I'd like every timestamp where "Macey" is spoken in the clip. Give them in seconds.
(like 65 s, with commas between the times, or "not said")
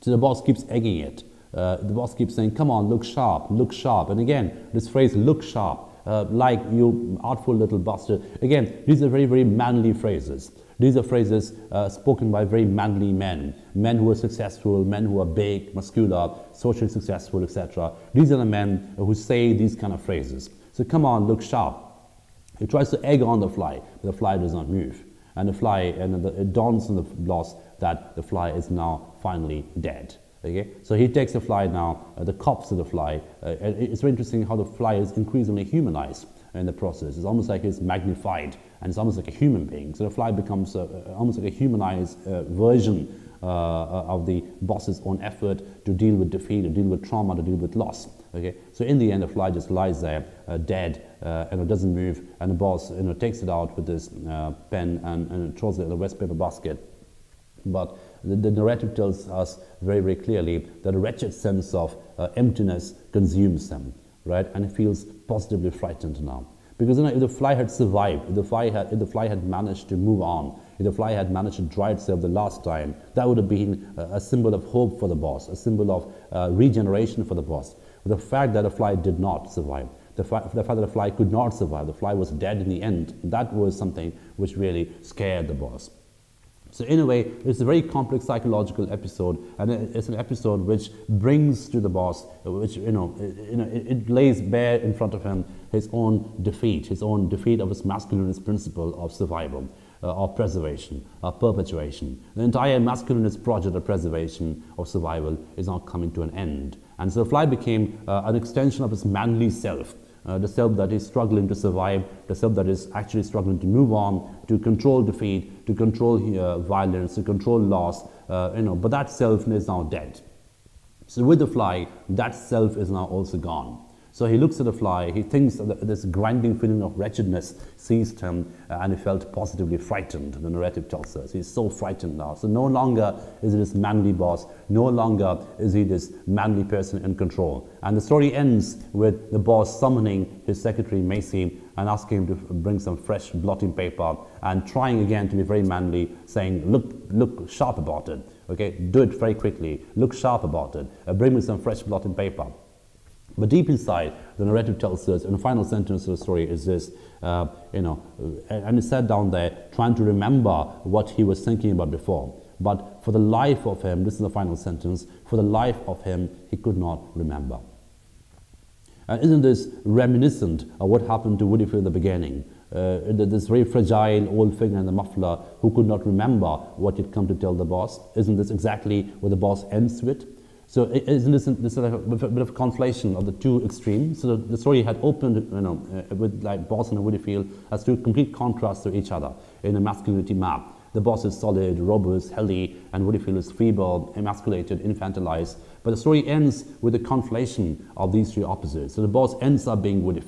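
141 s.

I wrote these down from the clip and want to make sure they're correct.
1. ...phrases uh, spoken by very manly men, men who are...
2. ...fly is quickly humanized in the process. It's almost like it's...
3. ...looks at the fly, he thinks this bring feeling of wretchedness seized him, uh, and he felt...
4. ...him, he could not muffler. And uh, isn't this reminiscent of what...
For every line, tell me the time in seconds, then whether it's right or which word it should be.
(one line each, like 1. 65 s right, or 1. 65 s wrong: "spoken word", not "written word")
1. 11 s right
2. 34 s wrong: "increasingly", not "quickly"
3. 124 s wrong: "grinding", not "bring"
4. 166 s wrong: "remember", not "muffler".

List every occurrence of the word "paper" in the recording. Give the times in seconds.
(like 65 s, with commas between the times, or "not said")
56 s, 143 s, 152 s.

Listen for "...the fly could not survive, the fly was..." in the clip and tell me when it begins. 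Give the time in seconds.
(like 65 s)
80 s.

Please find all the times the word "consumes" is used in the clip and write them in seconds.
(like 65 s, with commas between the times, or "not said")
63 s.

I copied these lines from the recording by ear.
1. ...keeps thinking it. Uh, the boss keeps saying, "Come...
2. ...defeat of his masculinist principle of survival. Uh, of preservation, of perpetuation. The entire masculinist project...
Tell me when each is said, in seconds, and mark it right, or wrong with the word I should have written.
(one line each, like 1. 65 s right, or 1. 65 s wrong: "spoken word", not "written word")
1. 0 s wrong: "egging", not "thinking"
2. 97 s right.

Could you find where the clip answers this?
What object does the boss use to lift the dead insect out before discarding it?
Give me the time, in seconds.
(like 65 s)
54 s.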